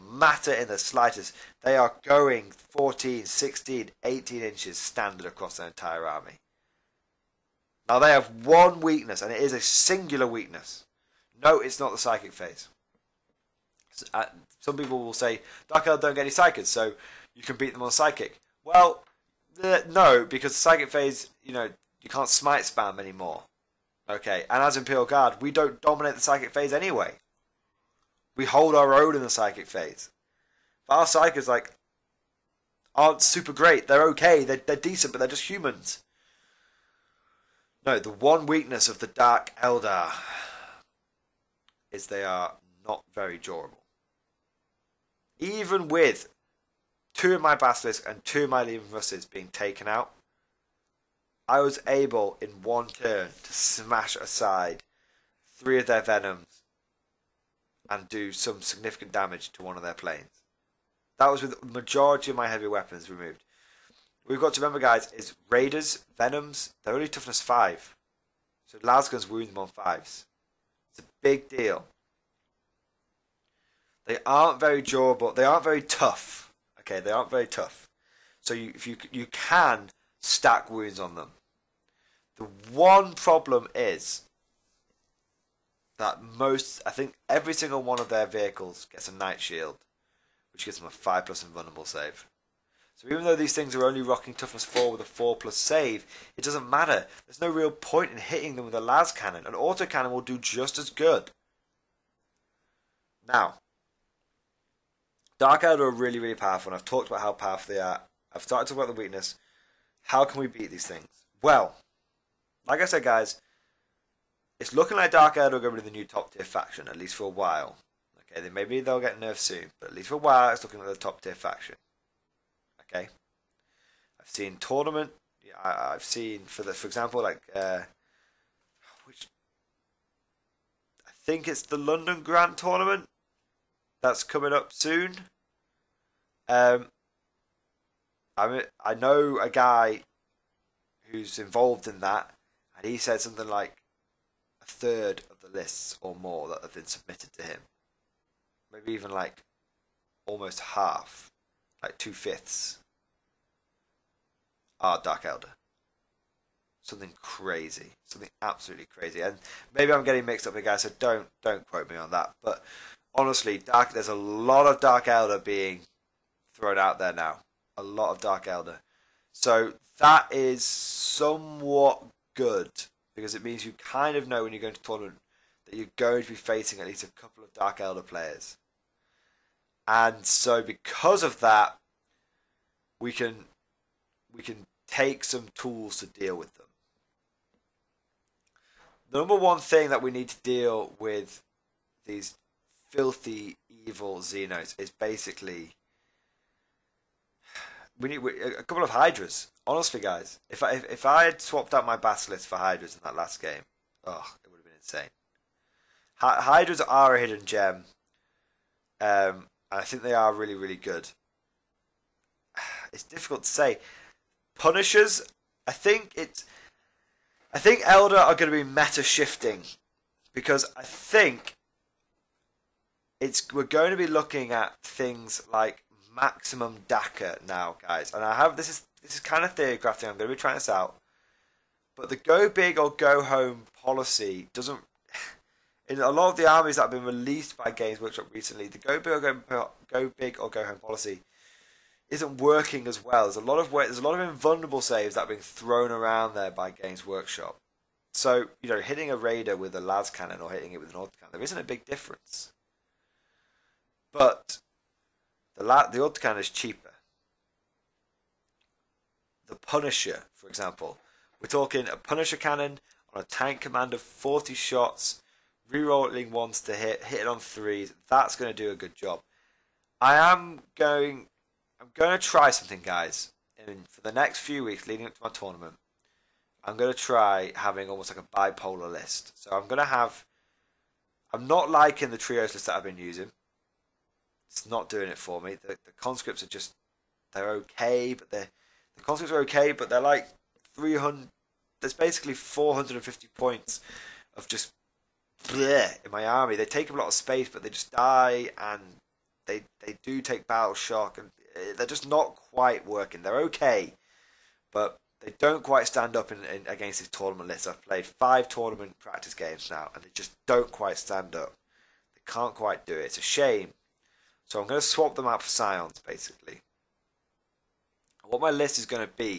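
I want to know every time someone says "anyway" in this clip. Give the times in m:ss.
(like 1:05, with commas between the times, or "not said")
0:26.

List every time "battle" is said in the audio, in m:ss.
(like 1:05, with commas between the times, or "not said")
5:00.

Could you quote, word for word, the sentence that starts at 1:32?
So even though these things are only rocking toughness 4 with a 4 plus save, it doesn't matter.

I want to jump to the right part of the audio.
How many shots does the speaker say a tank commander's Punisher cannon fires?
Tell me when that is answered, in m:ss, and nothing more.
4:24.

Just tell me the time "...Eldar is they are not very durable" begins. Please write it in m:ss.
0:39.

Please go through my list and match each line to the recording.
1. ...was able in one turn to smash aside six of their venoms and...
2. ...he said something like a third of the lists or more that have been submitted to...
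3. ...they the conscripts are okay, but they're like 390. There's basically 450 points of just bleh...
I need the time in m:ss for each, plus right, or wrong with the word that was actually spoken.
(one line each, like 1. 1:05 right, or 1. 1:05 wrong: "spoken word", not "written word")
1. 0:51 wrong: "three", not "six"
2. 2:22 right
3. 4:48 wrong: "300", not "390".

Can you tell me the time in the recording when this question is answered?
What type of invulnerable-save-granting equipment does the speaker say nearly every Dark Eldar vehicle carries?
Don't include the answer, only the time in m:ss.
1:29.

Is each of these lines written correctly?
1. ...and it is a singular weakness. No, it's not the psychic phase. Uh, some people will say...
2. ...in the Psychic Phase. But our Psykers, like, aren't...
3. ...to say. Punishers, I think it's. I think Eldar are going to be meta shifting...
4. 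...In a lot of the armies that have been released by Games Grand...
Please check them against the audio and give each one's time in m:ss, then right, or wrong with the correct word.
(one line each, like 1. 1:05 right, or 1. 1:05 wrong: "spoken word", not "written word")
1. 0:09 right
2. 0:29 right
3. 3:33 right
4. 3:55 wrong: "Workshop", not "Grand".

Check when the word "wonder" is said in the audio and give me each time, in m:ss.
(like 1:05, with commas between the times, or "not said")
not said.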